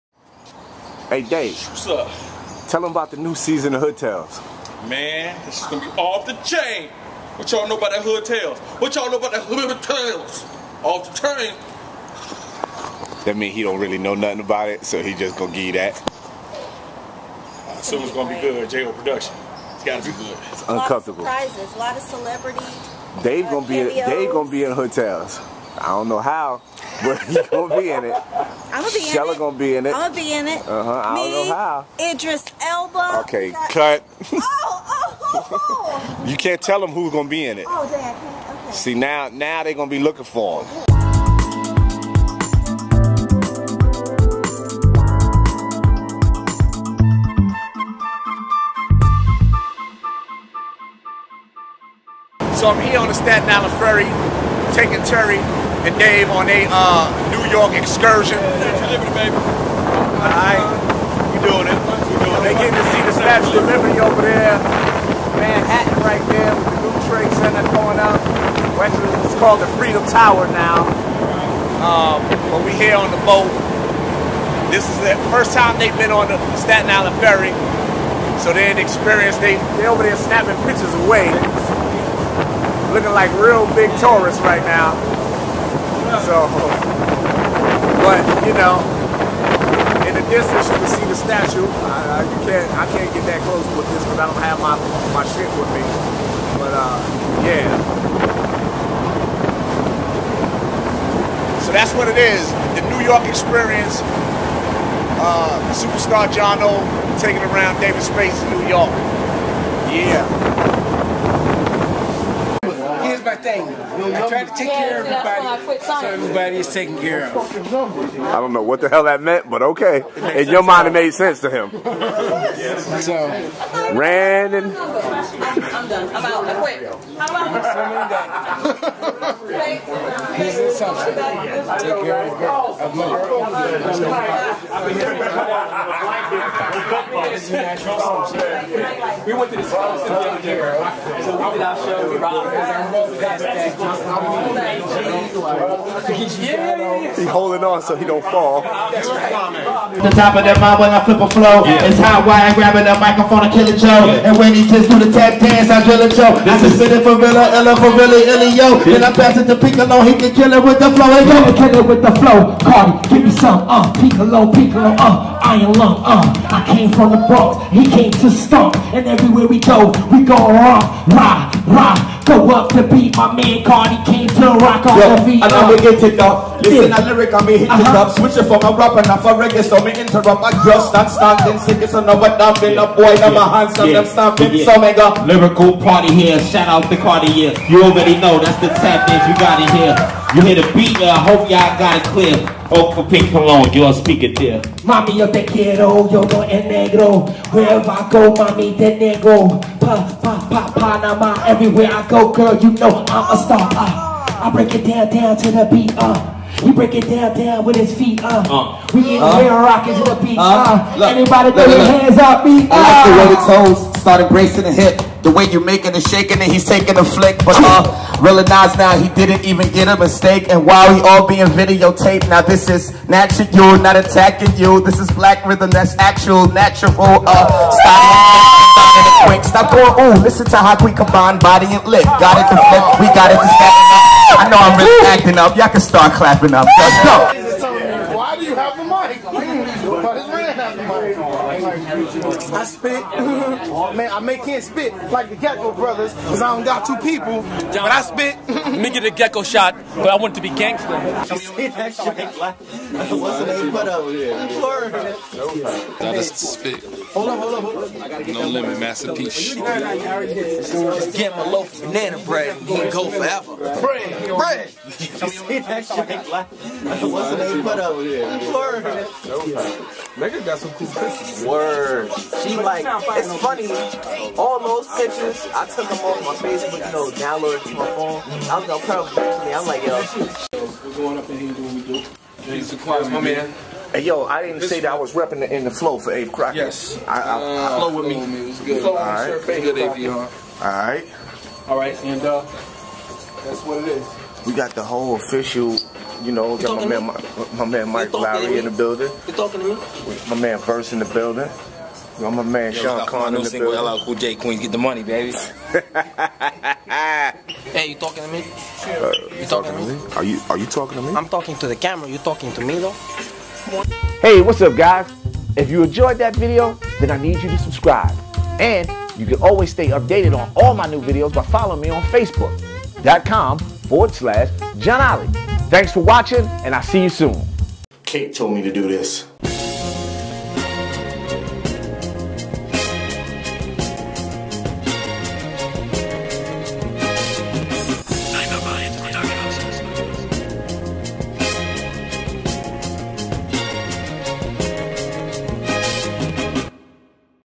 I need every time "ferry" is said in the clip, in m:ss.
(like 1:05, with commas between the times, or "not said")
0:53, 1:17.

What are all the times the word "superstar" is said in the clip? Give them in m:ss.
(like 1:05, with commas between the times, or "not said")
1:45.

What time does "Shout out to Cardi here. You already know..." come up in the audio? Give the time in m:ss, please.
3:06.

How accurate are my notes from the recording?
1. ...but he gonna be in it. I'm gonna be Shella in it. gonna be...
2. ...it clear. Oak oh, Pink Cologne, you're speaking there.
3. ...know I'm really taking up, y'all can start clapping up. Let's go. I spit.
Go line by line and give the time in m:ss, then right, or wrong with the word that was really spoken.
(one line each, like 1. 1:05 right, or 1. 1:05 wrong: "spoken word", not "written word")
1. 0:27 right
2. 3:11 right
3. 3:54 wrong: "acting", not "taking".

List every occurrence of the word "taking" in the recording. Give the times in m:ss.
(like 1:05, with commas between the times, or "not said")
0:54, 1:47, 3:36.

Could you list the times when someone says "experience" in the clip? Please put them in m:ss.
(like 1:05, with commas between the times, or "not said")
1:18, 1:43.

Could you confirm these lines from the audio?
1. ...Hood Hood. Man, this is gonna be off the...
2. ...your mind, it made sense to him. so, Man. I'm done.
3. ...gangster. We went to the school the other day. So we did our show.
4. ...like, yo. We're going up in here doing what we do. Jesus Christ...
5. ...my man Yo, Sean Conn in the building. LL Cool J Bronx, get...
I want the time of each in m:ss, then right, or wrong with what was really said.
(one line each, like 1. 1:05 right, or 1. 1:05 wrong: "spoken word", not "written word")
1. 0:03 wrong: "Tales", not "Hood"
2. 2:00 wrong: "Brandon", not "Man"
3. 2:12 wrong: "mother", not "gangster"
4. 4:39 right
5. 5:02 wrong: "Queens", not "Bronx".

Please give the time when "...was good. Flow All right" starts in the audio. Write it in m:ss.
4:48.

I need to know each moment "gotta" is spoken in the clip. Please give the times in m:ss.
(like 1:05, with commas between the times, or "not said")
0:19.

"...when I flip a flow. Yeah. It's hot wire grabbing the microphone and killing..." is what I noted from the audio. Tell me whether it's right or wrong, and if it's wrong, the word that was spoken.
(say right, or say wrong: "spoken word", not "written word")
right.